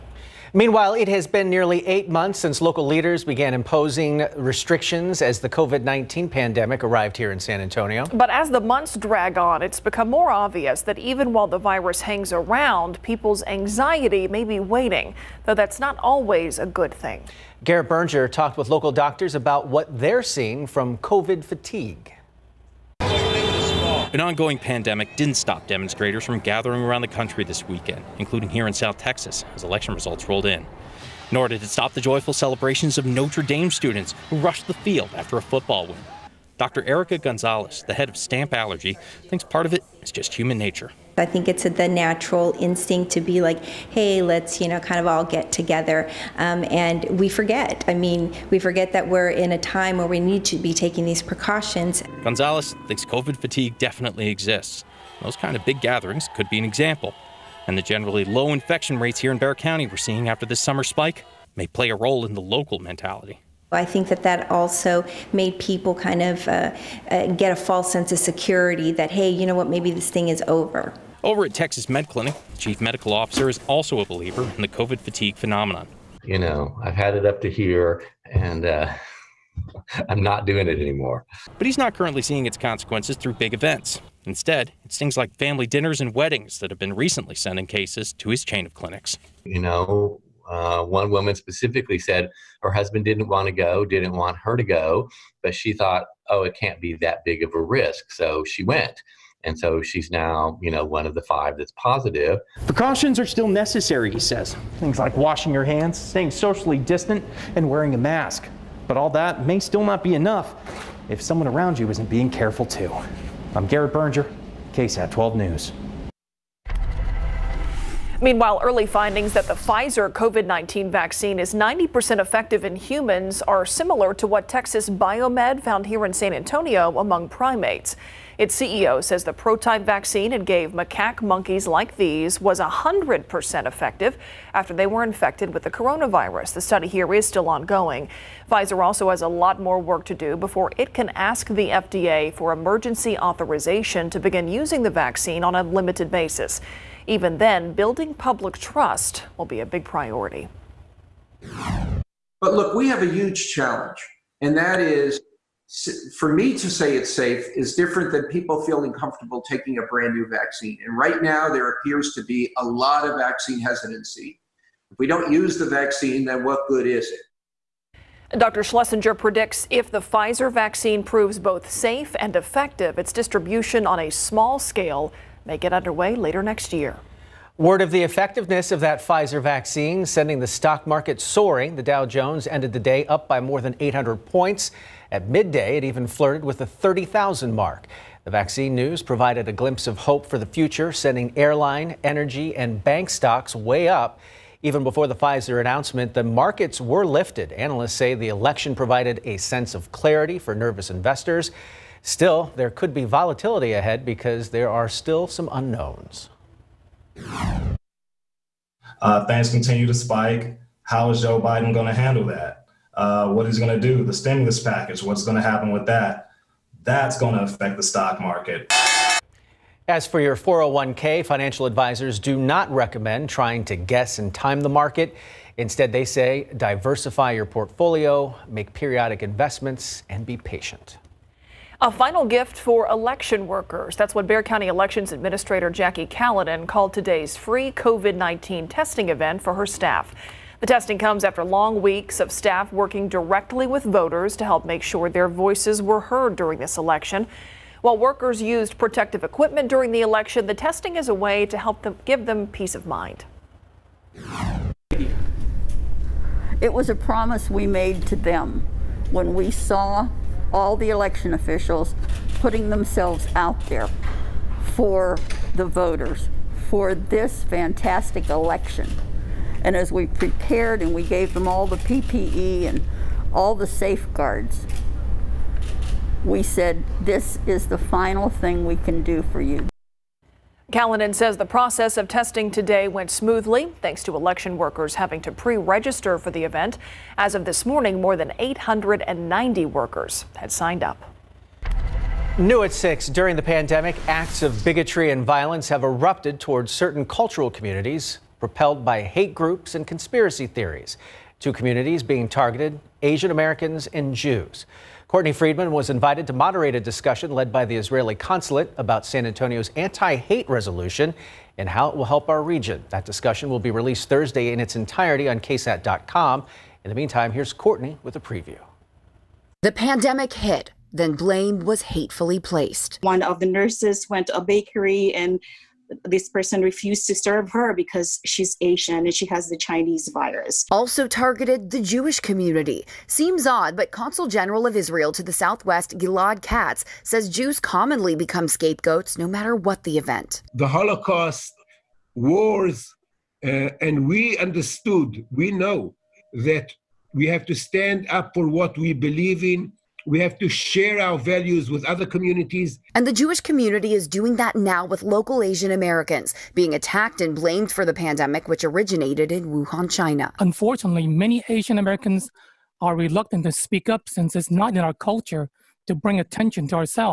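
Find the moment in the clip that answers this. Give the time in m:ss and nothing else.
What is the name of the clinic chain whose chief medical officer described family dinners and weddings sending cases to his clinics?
1:11.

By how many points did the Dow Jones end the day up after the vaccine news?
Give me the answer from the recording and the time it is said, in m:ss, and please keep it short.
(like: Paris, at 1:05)
800, at 3:03.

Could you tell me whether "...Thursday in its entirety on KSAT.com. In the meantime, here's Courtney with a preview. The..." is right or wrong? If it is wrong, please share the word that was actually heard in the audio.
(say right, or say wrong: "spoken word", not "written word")
right.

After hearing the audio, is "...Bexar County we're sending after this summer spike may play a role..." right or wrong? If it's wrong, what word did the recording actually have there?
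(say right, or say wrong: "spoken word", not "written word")
wrong: "seeing", not "sending".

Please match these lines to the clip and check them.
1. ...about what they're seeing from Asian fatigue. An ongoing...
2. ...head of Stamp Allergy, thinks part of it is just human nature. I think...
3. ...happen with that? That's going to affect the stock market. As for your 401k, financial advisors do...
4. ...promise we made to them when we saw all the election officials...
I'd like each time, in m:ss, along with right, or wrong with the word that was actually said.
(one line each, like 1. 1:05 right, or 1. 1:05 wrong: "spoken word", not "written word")
1. 0:19 wrong: "COVID", not "Asian"
2. 0:37 right
3. 3:35 right
4. 4:16 right.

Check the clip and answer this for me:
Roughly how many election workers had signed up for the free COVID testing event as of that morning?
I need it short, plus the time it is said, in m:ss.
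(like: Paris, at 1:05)
890, at 4:48.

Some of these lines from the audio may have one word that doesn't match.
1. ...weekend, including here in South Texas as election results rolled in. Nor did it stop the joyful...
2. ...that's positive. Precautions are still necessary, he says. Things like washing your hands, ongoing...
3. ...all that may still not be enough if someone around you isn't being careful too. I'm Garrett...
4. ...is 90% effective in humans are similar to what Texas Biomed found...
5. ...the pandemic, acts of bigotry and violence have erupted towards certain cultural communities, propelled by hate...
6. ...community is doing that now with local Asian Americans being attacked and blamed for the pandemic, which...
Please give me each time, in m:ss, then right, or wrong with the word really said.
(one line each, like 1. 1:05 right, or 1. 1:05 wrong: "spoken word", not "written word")
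1. 0:27 right
2. 1:41 wrong: "staying", not "ongoing"
3. 1:48 right
4. 2:01 right
5. 4:53 right
6. 5:53 right.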